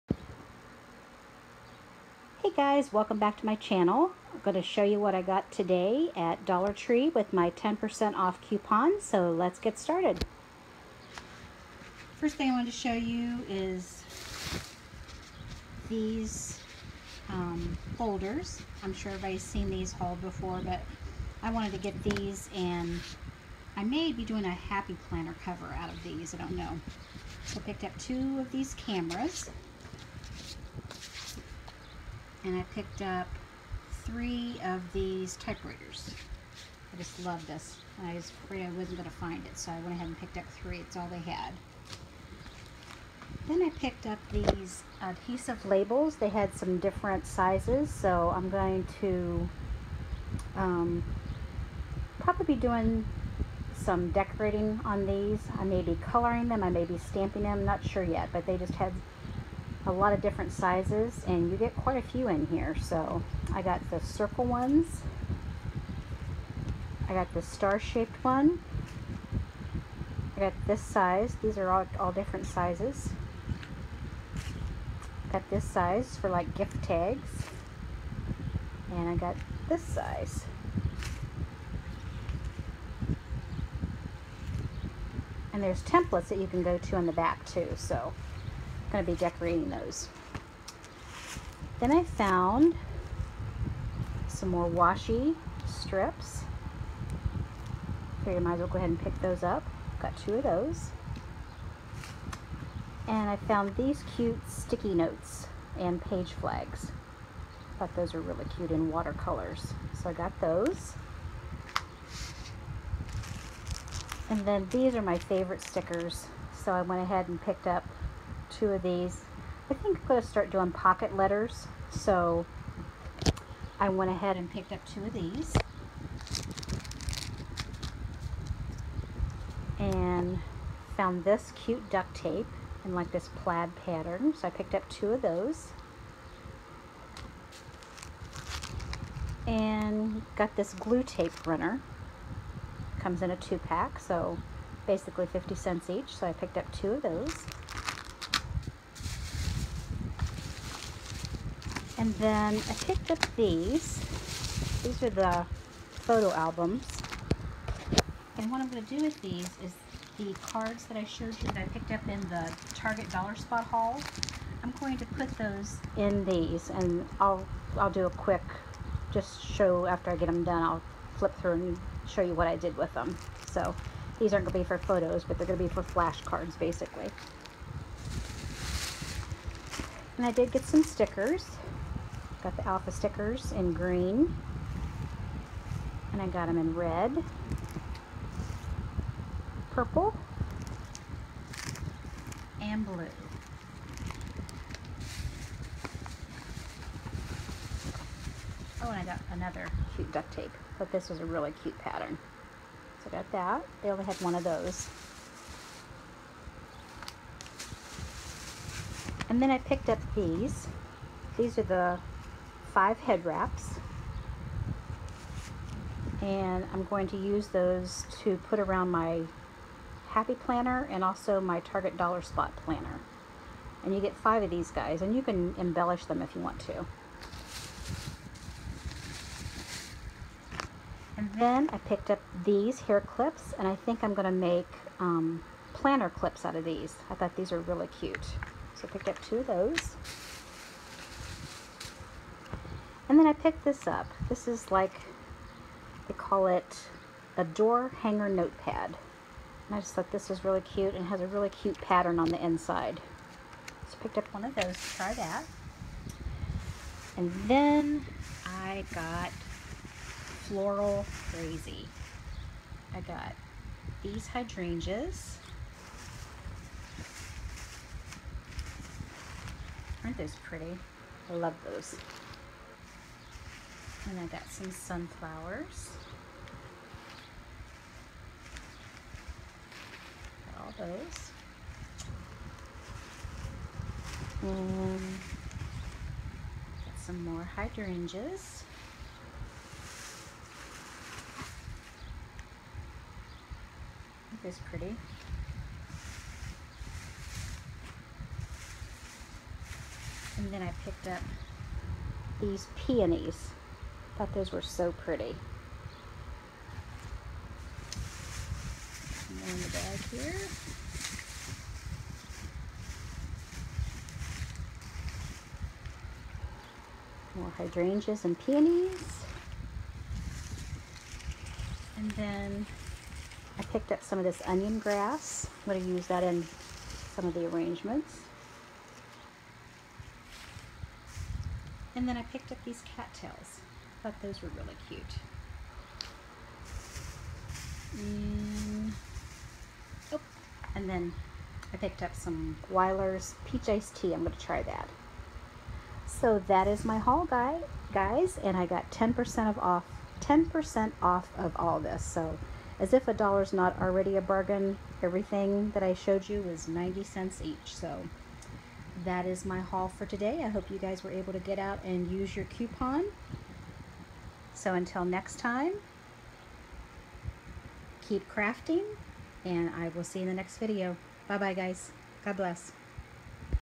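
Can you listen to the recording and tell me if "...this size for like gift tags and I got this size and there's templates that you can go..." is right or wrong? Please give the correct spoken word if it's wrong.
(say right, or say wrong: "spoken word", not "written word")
right.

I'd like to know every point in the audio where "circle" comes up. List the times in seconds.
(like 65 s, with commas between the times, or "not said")
63 s.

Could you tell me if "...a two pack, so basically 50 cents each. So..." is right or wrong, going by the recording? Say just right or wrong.
right.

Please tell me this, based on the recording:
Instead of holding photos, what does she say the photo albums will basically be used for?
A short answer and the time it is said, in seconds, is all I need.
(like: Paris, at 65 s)
flashcards, at 175 s.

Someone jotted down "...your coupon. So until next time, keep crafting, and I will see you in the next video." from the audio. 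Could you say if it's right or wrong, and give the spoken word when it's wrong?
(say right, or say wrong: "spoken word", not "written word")
right.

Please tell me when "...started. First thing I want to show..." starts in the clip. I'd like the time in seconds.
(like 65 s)
9 s.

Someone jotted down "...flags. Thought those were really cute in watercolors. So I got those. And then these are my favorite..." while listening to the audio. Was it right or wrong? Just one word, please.
right.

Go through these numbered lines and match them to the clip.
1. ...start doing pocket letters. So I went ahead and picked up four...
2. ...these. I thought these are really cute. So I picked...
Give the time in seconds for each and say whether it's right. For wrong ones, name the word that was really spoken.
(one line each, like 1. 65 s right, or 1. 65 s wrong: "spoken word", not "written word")
1. 120 s wrong: "two", not "four"
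2. 236 s right.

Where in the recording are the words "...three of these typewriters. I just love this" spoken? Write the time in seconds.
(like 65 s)
34 s.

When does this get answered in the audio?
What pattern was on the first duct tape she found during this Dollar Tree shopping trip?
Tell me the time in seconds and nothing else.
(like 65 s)
133 s.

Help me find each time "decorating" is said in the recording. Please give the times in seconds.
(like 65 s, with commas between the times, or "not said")
54 s, 89 s.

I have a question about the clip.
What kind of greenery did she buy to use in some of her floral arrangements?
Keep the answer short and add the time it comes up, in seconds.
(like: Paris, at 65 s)
onion grass, at 324 s.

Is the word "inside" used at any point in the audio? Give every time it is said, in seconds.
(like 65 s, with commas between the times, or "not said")
252 s.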